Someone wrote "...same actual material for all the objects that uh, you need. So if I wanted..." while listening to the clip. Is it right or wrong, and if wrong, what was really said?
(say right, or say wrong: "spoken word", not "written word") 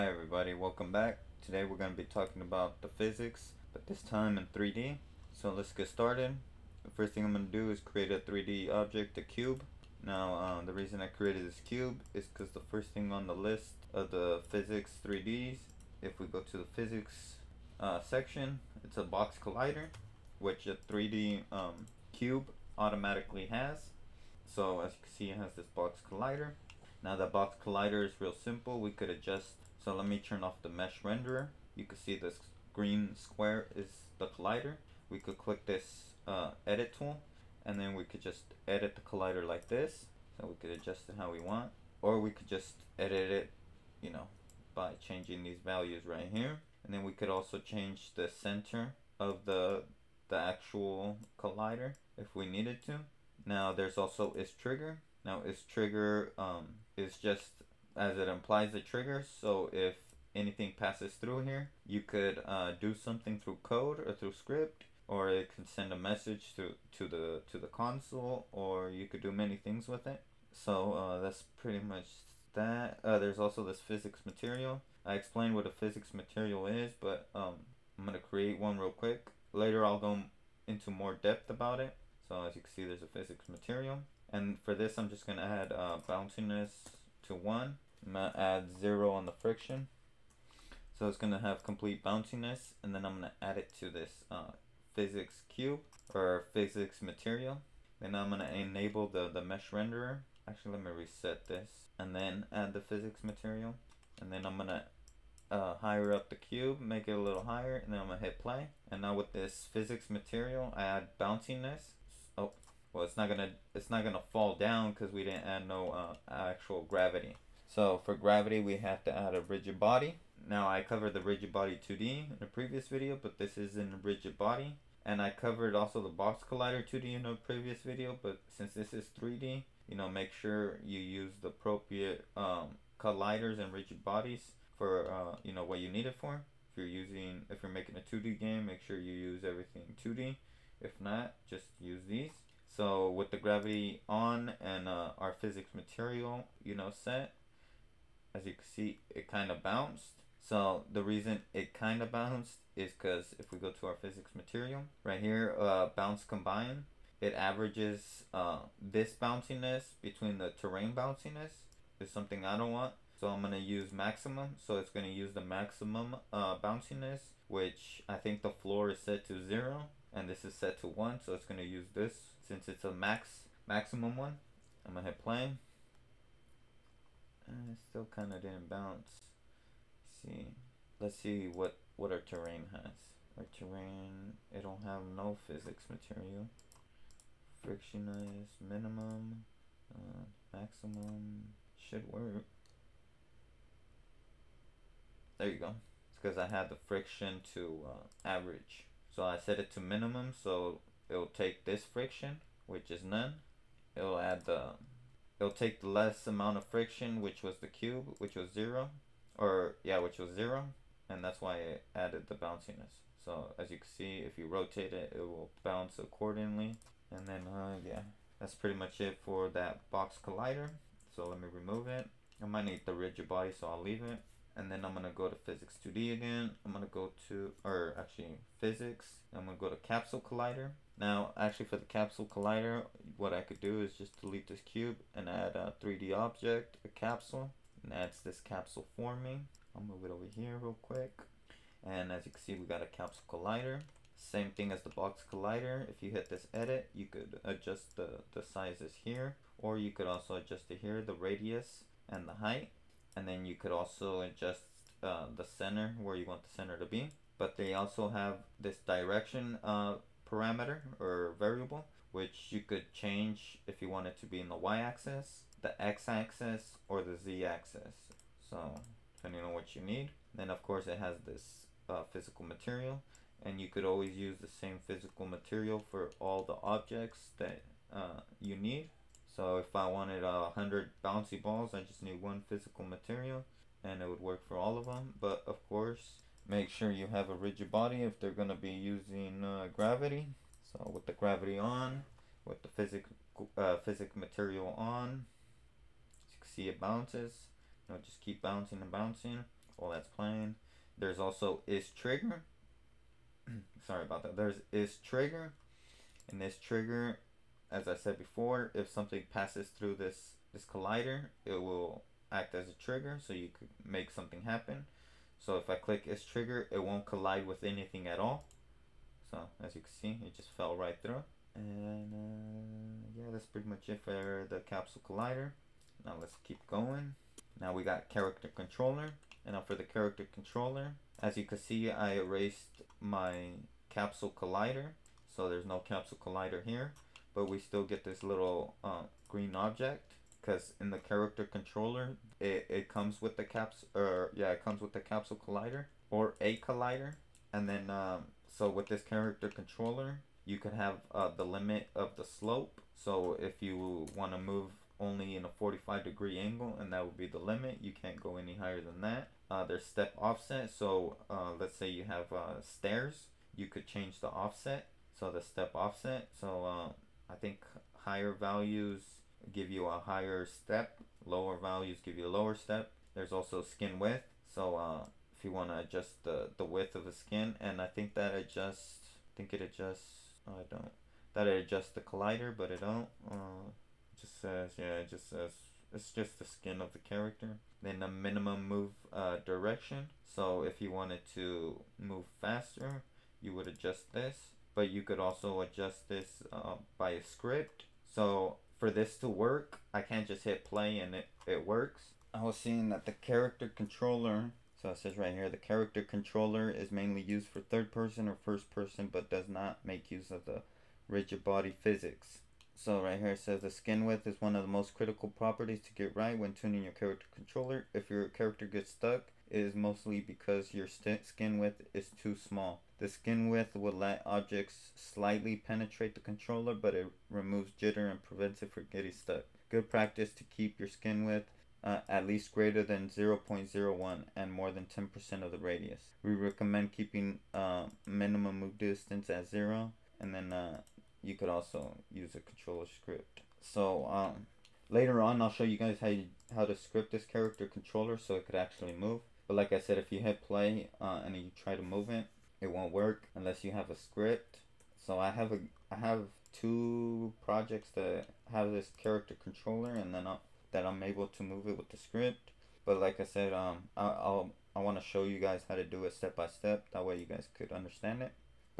wrong: "physical", not "actual".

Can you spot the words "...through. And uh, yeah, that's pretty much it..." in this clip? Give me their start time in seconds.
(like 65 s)
321 s.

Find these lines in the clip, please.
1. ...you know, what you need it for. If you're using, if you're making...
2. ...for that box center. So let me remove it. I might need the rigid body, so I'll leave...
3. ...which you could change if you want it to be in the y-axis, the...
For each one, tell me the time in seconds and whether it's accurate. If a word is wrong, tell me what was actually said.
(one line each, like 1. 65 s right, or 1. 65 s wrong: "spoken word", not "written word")
1. 135 s right
2. 219 s wrong: "collider", not "center"
3. 262 s right.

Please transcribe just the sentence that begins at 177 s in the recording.
And it still kind of didn't bounce.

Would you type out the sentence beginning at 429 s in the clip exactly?
Good practice to keep your skin width uh, at least greater than 0.01 and more than 10% of the radius.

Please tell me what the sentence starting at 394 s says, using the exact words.
But you could also adjust this uh, by a script.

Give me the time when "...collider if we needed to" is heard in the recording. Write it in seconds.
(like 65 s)
51 s.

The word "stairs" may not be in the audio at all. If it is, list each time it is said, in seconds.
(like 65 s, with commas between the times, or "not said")
362 s.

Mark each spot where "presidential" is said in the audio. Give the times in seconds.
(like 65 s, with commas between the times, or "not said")
not said.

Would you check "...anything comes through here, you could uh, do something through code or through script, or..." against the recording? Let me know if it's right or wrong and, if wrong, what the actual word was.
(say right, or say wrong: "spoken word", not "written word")
wrong: "passes", not "comes".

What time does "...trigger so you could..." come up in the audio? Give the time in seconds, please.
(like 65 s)
312 s.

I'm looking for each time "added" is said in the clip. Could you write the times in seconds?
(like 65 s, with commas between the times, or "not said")
211 s.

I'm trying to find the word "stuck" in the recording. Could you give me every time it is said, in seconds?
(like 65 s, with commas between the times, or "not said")
418 s, 429 s.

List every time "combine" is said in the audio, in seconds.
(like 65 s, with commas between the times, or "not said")
156 s.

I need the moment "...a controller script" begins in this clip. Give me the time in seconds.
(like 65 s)
442 s.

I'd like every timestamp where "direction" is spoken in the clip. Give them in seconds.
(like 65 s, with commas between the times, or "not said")
258 s, 389 s.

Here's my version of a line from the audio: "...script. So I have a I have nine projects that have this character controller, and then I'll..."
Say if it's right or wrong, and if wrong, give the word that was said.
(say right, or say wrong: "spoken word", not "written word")
wrong: "two", not "nine".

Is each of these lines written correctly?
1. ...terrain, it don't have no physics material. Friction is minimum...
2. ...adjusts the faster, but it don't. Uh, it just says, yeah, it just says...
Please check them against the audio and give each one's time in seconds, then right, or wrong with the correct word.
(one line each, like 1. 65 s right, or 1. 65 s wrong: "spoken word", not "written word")
1. 183 s right
2. 381 s wrong: "collider", not "faster".